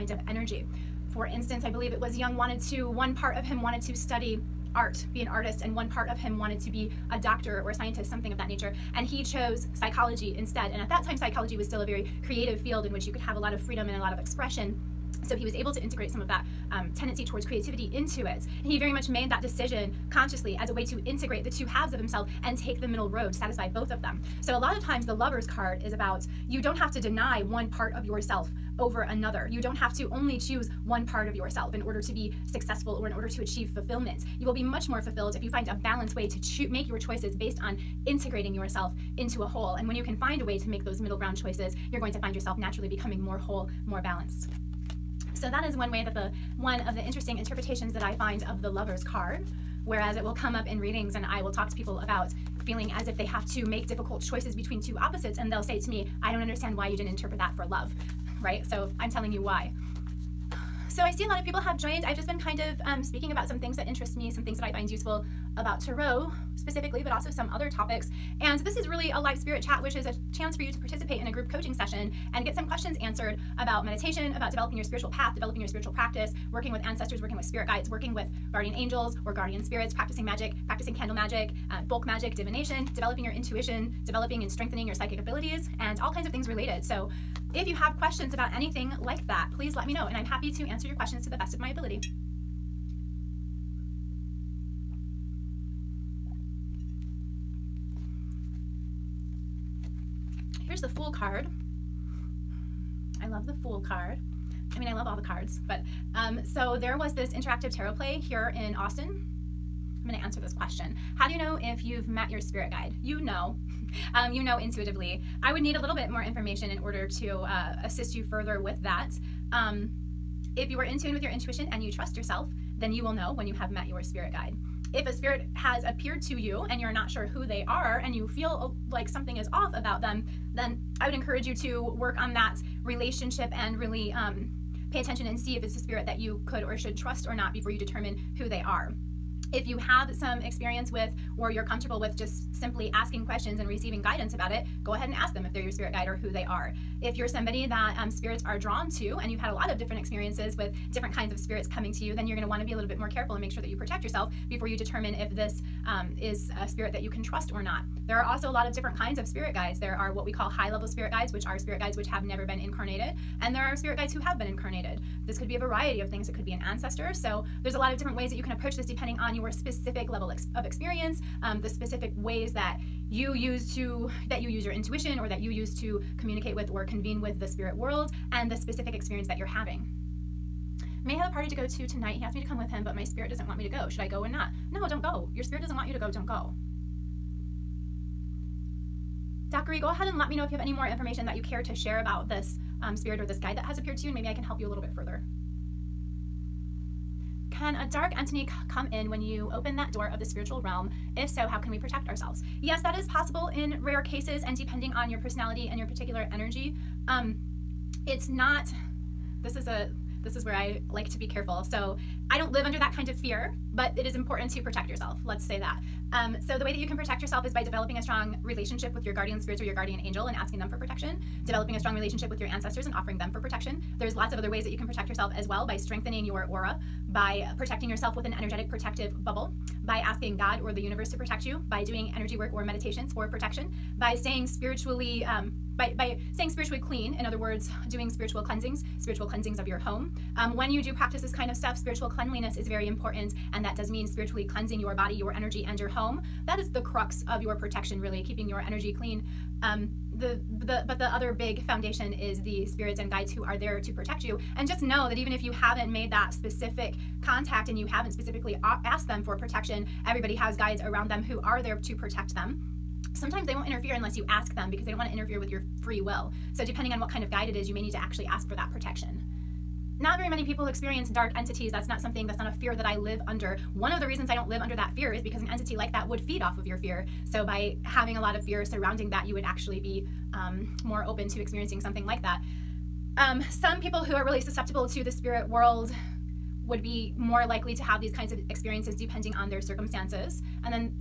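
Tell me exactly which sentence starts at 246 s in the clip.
That is the crux of your protection, really, keeping your energy clean.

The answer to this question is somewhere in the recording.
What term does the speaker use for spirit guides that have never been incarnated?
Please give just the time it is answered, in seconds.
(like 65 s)
160 s.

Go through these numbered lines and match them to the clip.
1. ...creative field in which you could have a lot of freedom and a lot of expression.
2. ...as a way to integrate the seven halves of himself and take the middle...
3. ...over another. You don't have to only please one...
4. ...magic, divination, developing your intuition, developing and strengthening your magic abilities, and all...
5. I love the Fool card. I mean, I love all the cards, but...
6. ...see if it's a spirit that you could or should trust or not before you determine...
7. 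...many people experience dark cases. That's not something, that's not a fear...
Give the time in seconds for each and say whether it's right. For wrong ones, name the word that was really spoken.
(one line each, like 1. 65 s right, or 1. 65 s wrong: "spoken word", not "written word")
1. 12 s right
2. 20 s wrong: "two", not "seven"
3. 28 s wrong: "choose", not "please"
4. 82 s wrong: "psychic", not "magic"
5. 103 s right
6. 135 s right
7. 270 s wrong: "entities", not "cases".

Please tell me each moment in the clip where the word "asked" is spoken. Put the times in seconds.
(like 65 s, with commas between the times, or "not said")
182 s, 258 s.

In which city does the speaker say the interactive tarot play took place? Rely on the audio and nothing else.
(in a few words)
Austin.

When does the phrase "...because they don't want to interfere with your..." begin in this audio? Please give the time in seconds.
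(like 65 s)
264 s.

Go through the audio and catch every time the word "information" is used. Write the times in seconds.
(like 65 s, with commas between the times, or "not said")
116 s, 190 s.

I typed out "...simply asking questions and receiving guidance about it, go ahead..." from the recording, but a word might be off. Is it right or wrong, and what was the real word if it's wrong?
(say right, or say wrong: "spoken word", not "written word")
right.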